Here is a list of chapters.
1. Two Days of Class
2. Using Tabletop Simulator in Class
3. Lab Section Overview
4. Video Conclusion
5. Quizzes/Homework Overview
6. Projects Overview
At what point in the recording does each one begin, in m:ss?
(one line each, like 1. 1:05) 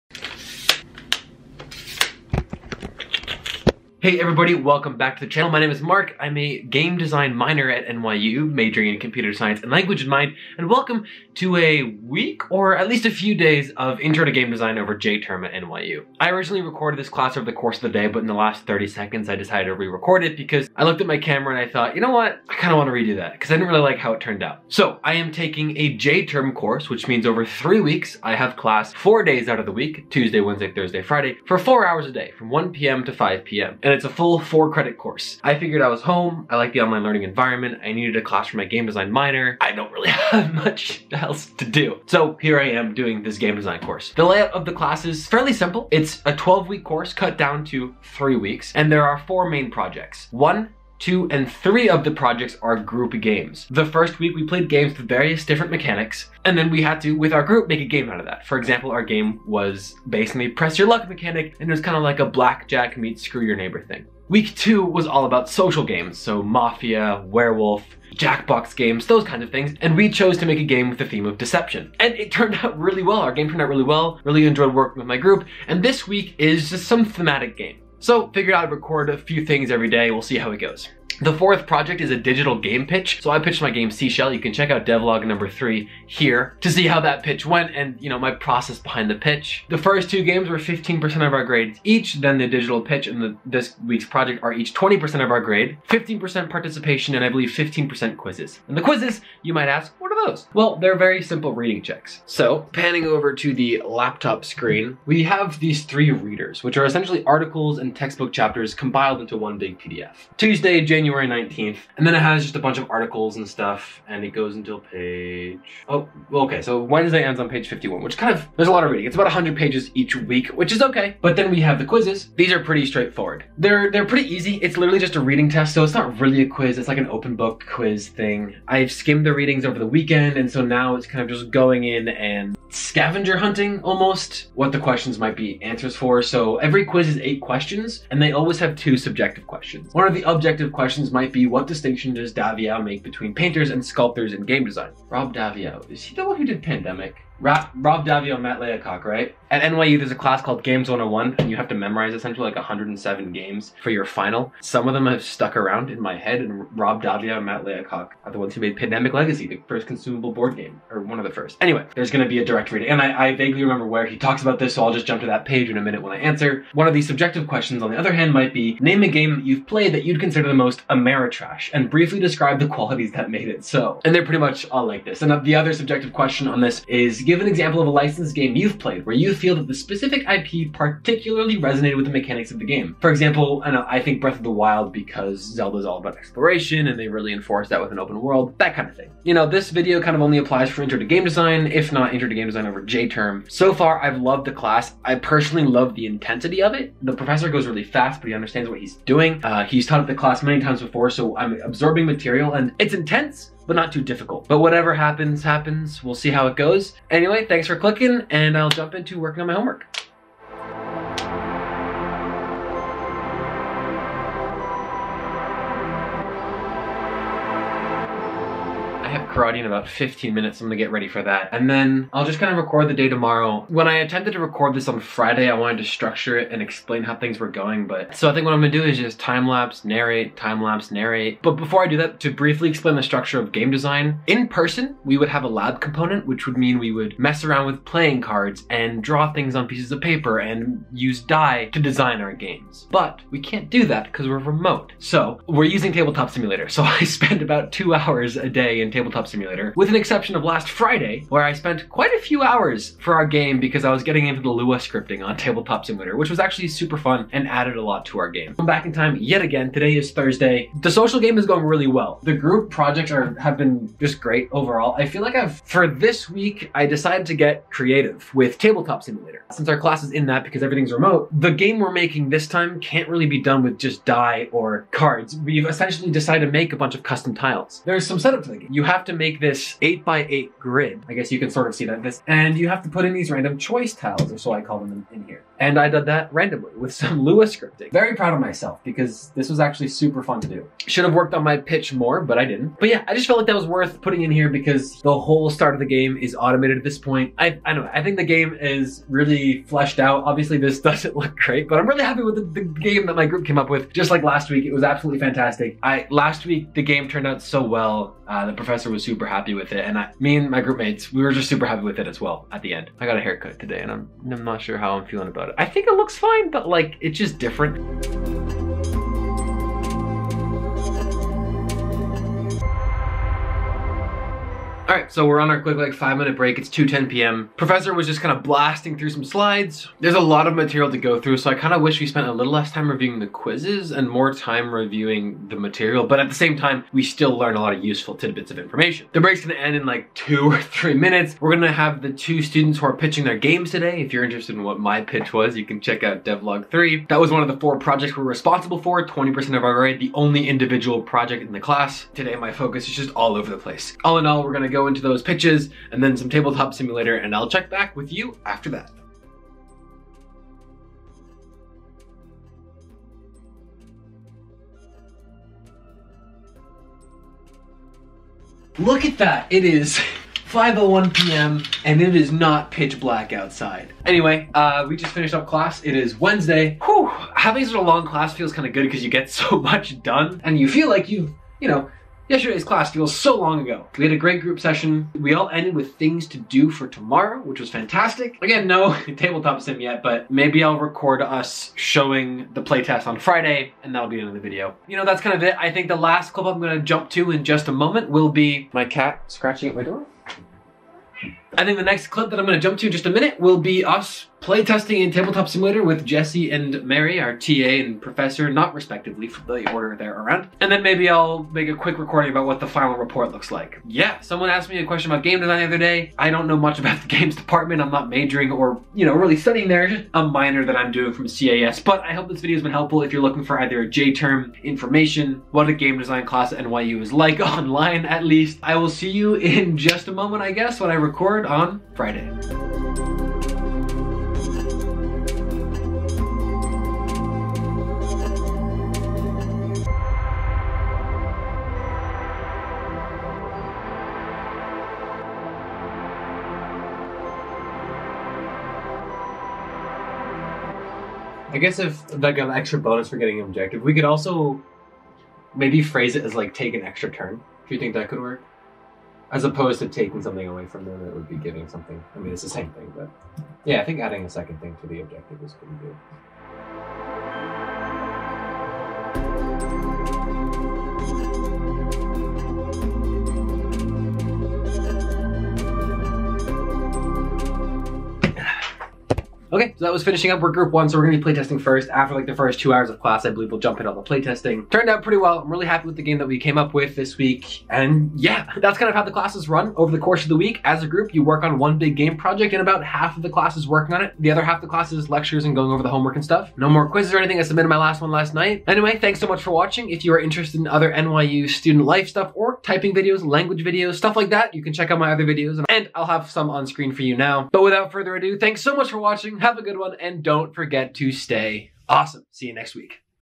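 1. 5:12
2. 4:30
3. 3:46
4. 8:20
5. 1:38
6. 0:44.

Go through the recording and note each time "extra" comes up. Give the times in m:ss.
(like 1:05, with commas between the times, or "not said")
7:32, 7:36.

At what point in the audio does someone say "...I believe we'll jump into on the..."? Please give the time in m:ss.
8:03.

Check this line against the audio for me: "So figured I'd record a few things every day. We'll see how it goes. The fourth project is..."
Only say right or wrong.
right.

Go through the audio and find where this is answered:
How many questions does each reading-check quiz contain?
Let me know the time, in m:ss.
2:17.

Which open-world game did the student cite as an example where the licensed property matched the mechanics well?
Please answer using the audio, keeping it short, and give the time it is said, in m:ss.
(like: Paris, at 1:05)
Breath of the Wild, at 3:04.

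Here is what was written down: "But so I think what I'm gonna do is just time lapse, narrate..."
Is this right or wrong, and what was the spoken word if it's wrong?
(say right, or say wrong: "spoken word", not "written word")
right.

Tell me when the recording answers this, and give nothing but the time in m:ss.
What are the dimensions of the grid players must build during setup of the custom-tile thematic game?
4:39.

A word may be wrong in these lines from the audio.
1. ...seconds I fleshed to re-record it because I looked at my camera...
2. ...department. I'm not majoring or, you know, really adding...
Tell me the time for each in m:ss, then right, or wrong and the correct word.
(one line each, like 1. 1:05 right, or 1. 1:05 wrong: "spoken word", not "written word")
1. 0:18 wrong: "decided", not "fleshed"
2. 6:57 wrong: "studying", not "adding".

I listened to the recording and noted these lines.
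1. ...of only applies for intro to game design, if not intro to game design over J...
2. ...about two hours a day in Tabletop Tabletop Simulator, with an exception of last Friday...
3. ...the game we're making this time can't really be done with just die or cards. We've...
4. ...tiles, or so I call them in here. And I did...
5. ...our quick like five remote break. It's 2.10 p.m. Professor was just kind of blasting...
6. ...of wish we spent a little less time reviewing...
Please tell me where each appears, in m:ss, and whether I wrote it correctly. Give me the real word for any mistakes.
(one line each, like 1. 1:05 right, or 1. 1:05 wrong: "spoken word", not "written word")
1. 3:10 right
2. 4:07 right
3. 4:31 right
4. 4:43 right
5. 5:25 wrong: "minute", not "remote"
6. 5:31 right.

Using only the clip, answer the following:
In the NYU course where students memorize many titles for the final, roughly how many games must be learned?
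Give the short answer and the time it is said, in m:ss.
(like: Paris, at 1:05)
107, at 2:32.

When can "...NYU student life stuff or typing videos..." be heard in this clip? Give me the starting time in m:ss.
8:20.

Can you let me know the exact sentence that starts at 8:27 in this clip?
But without further ado, thanks so much for watching.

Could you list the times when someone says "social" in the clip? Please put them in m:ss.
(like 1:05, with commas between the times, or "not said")
1:05, 4:20.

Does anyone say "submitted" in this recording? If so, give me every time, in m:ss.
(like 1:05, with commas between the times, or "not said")
8:17.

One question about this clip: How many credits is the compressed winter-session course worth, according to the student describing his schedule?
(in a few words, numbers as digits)
4.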